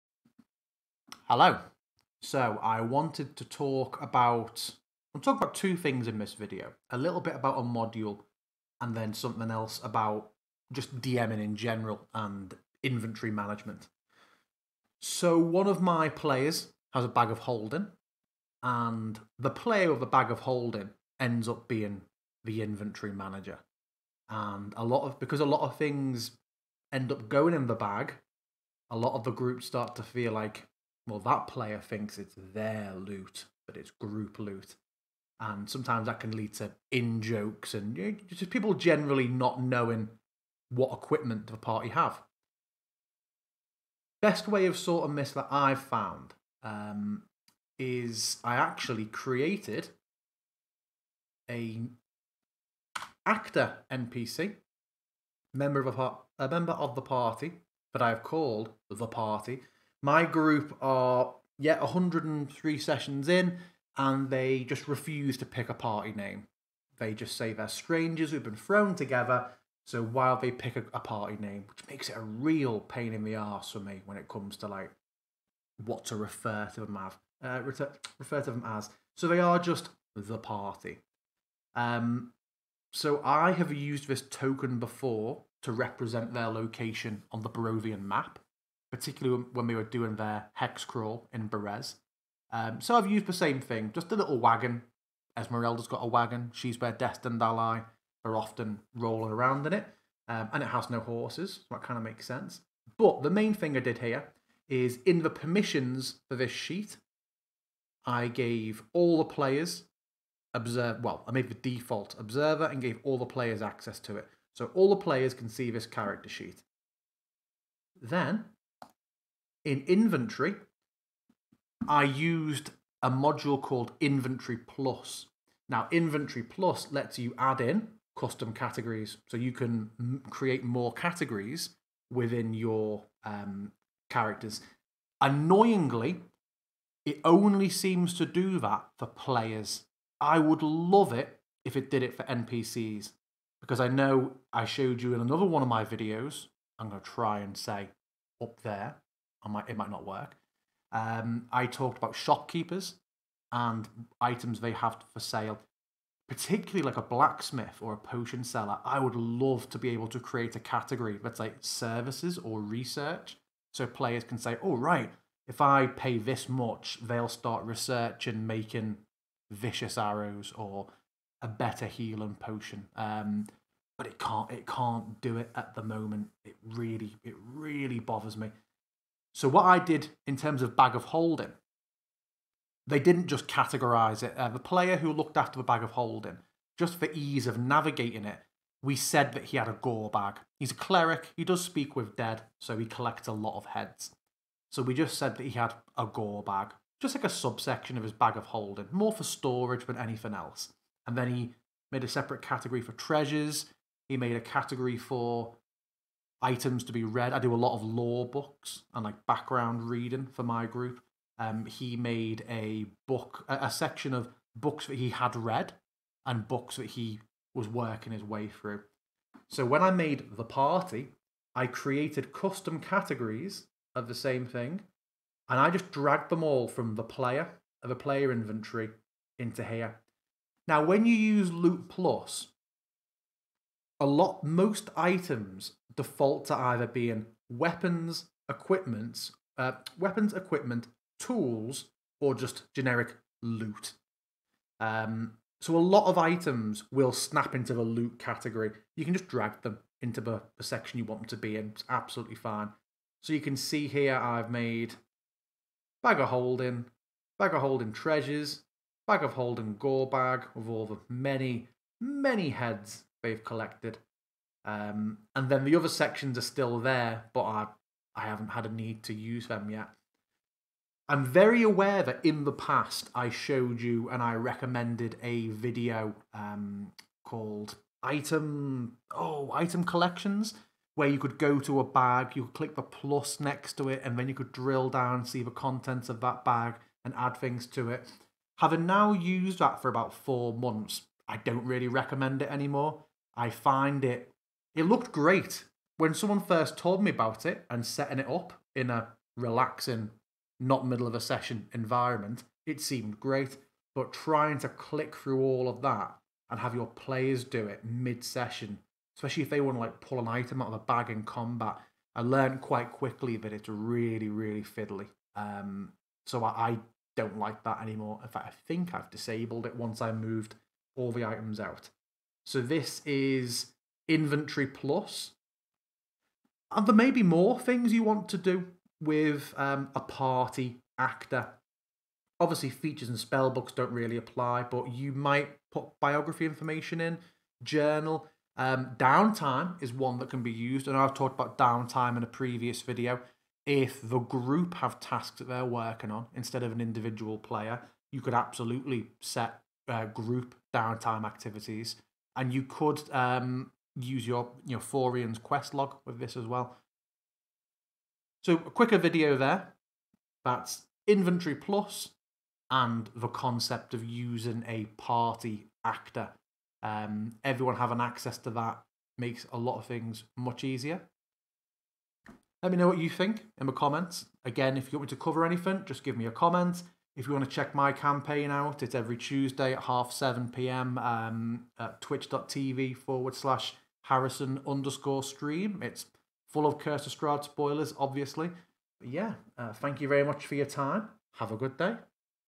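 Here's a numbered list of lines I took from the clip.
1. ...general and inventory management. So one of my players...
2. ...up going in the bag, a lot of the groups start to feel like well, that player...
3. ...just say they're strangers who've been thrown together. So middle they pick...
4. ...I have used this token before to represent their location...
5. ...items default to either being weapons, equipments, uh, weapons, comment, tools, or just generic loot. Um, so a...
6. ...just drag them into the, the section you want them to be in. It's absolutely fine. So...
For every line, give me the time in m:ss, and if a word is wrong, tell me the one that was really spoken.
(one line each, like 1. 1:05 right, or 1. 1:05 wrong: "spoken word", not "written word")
1. 0:11 right
2. 0:27 right
3. 1:07 wrong: "while", not "middle"
4. 1:23 right
5. 3:54 wrong: "equipment", not "comment"
6. 4:09 right.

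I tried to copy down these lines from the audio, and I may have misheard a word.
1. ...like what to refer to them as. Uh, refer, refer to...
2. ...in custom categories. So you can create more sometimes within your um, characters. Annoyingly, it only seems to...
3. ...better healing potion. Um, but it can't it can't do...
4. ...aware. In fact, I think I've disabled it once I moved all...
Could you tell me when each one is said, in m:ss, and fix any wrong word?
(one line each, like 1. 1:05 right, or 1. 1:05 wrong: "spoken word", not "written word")
1. 1:14 right
2. 2:07 wrong: "categories", not "sometimes"
3. 2:51 right
4. 5:17 wrong: "anymore", not "aware".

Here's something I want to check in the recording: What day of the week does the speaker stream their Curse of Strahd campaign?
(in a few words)
Tuesday.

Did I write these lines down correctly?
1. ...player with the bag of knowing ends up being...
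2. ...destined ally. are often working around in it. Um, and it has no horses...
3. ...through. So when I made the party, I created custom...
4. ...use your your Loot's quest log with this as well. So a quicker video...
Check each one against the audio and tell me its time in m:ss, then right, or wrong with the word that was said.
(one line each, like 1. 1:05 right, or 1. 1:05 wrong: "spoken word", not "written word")
1. 0:19 wrong: "holding", not "knowing"
2. 1:36 wrong: "rolling", not "working"
3. 3:38 right
4. 5:53 wrong: "Forien", not "Loot".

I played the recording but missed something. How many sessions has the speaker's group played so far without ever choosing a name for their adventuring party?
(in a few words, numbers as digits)
103.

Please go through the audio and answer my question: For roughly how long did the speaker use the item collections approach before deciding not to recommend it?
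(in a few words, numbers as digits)
about four months.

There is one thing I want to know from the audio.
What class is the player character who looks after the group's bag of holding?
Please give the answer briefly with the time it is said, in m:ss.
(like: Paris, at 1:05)
cleric, at 3:10.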